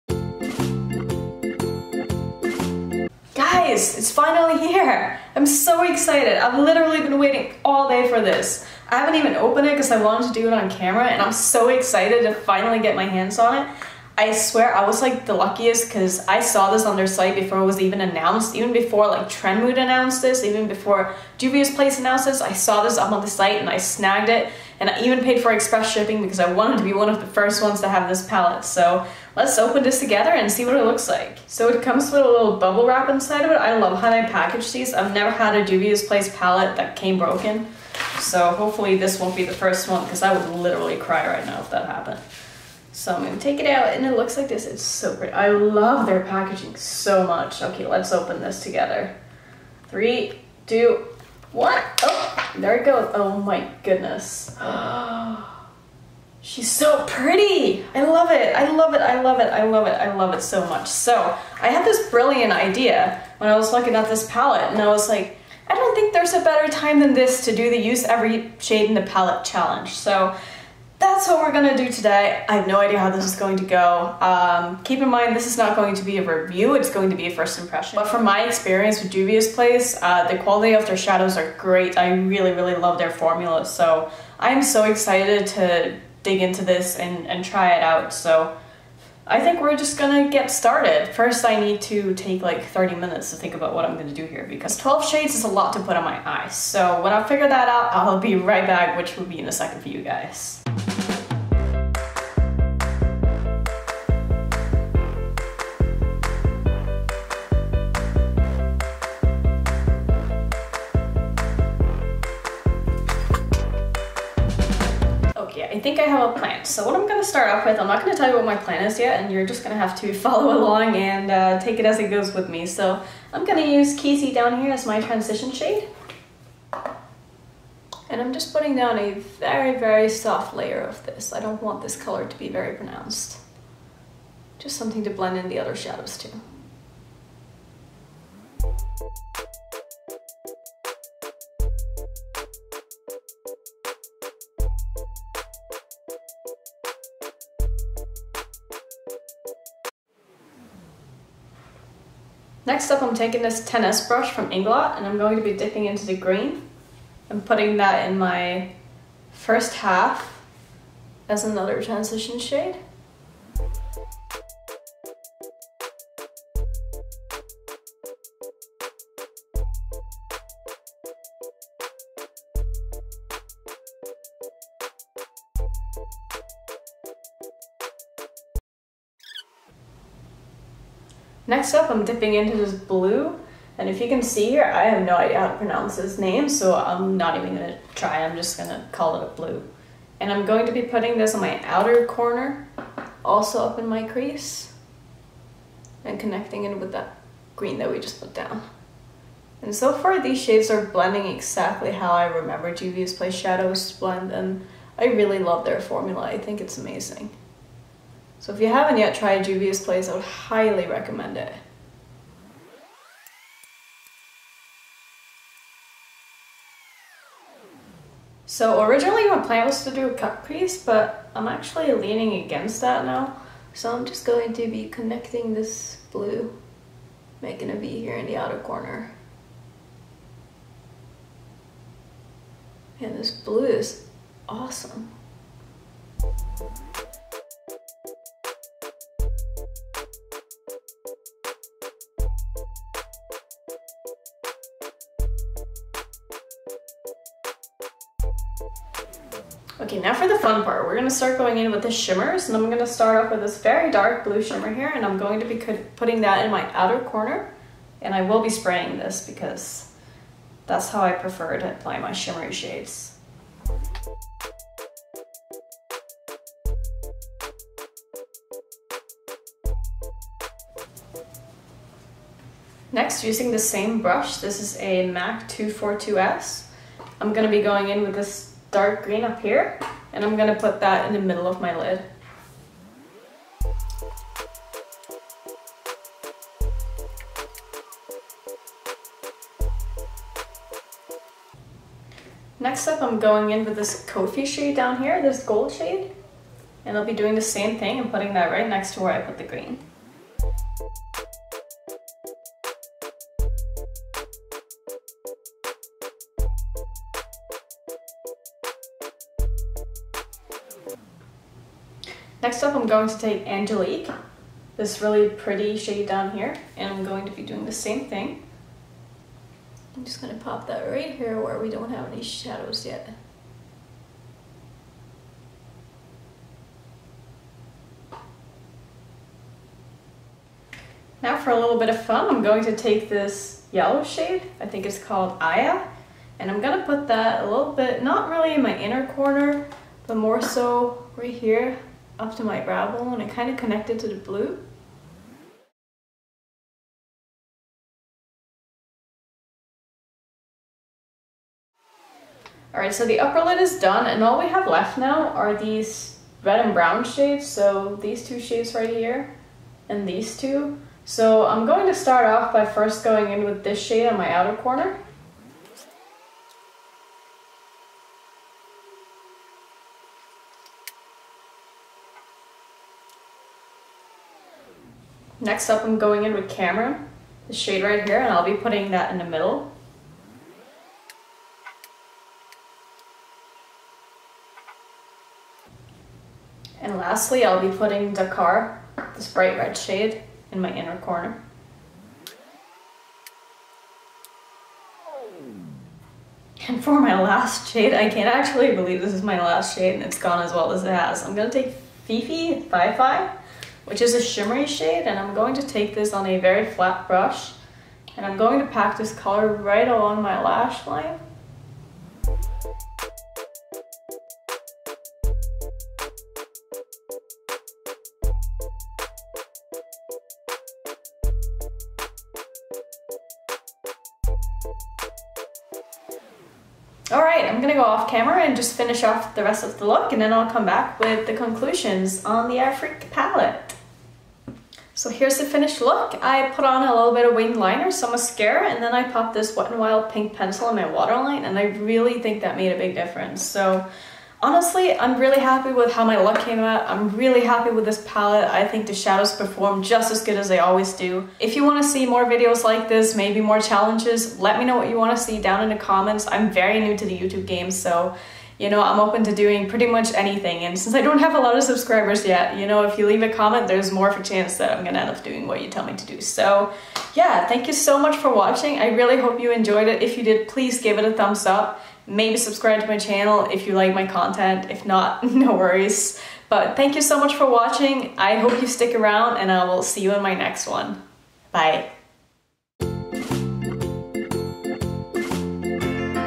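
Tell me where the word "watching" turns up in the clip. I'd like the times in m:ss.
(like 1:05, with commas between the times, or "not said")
7:48, 7:57.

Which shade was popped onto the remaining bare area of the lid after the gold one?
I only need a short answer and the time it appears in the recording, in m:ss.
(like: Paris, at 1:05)
Angelique, at 5:13.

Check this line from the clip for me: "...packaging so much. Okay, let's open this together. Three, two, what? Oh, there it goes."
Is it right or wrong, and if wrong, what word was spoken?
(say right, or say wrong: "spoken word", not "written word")
right.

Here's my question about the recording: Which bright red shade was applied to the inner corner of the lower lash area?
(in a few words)
Dakar.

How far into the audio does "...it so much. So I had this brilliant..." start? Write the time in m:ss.
1:00.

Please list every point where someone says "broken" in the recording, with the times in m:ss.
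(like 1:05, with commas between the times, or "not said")
0:37.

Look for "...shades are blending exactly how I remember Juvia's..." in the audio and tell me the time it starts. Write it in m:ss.
3:20.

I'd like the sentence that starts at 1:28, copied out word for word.
So I think we're just gonna get started.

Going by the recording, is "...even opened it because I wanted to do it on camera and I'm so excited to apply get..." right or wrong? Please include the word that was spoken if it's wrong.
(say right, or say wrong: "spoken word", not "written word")
wrong: "finally", not "apply".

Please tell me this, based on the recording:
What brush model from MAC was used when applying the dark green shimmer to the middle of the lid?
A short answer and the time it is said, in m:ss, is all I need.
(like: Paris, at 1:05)
242S, at 4:35.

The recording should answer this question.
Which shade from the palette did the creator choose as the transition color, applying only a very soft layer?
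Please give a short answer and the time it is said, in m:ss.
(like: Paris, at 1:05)
Casey, at 2:03.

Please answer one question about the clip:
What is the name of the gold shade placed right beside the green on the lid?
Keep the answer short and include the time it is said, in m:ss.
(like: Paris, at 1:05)
Kofi, at 4:54.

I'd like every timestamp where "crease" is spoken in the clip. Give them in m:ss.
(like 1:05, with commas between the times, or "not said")
3:14, 3:40.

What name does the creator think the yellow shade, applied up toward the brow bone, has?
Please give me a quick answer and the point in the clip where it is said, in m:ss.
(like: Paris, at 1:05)
Aya, at 5:35.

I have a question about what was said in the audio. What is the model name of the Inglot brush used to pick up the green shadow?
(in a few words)
10S.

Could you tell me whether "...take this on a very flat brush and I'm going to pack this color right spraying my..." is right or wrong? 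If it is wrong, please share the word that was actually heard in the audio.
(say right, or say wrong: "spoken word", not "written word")
wrong: "along", not "spraying".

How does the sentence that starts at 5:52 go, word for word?
Alright, so the upper lid is done and all we have left now are these red and brown shades.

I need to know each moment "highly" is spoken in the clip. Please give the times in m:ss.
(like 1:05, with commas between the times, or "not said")
3:30.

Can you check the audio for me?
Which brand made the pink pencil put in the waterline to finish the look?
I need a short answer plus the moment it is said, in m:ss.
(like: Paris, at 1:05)
Wet n Wild, at 7:19.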